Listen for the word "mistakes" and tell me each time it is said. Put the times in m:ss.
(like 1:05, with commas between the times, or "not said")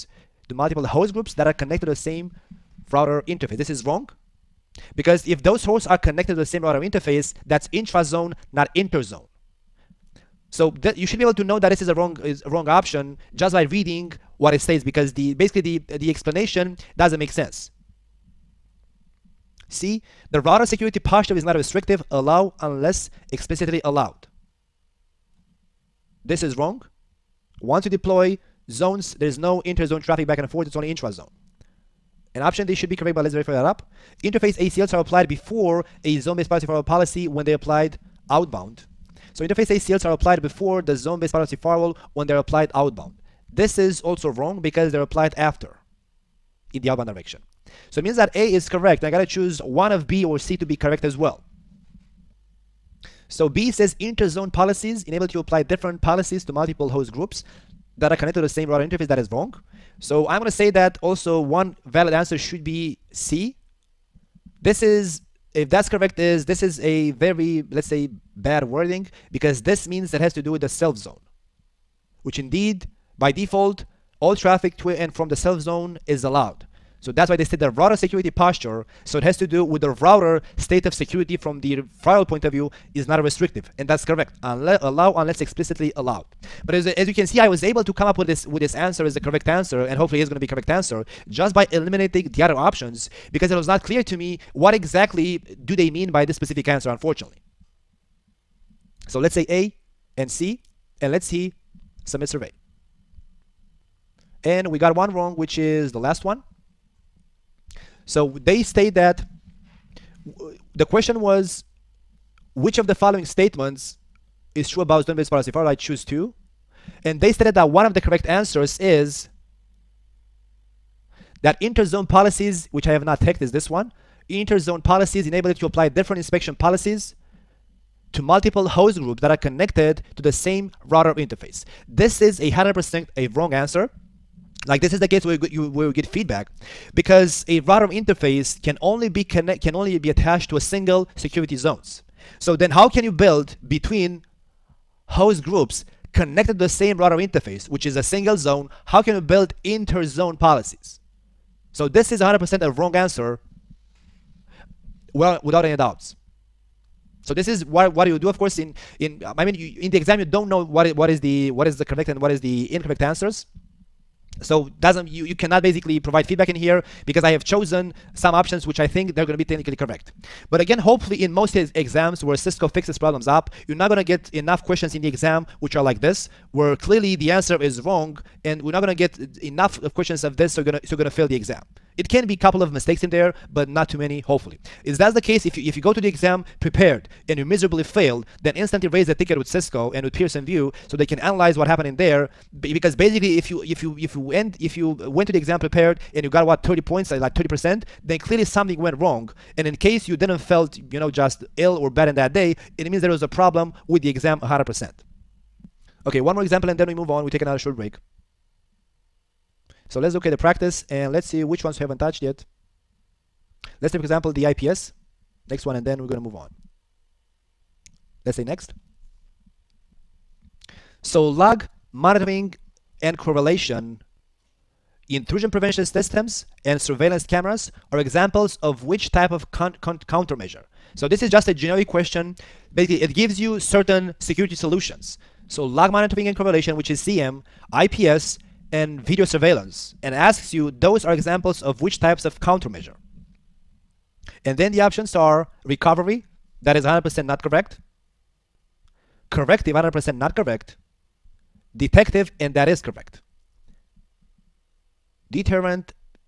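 3:02.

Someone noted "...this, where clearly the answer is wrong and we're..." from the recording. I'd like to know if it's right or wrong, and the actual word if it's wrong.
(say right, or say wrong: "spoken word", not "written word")
right.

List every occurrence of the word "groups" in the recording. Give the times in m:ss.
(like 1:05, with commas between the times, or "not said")
0:01, 0:57, 2:08, 2:25.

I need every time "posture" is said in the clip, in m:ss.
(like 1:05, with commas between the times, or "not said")
0:20, 1:18.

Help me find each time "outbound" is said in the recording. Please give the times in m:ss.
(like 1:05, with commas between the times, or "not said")
0:38, 0:42, 0:46.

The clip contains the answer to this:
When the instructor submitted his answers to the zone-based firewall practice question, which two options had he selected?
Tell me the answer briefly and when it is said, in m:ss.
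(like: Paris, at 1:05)
A and C, at 1:39.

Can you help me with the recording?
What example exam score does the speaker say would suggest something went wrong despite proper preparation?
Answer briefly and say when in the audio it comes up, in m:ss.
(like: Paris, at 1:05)
30 percent, at 3:17.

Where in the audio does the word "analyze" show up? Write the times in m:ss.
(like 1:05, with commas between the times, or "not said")
3:11.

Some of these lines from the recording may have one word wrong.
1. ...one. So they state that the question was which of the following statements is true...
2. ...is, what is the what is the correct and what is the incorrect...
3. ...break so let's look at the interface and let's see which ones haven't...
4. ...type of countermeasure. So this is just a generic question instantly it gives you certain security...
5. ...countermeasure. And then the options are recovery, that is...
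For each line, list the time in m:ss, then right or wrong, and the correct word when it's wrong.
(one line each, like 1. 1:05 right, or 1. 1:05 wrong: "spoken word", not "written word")
1. 1:46 right
2. 2:40 right
3. 3:27 wrong: "practice", not "interface"
4. 3:49 wrong: "basically", not "instantly"
5. 4:02 right.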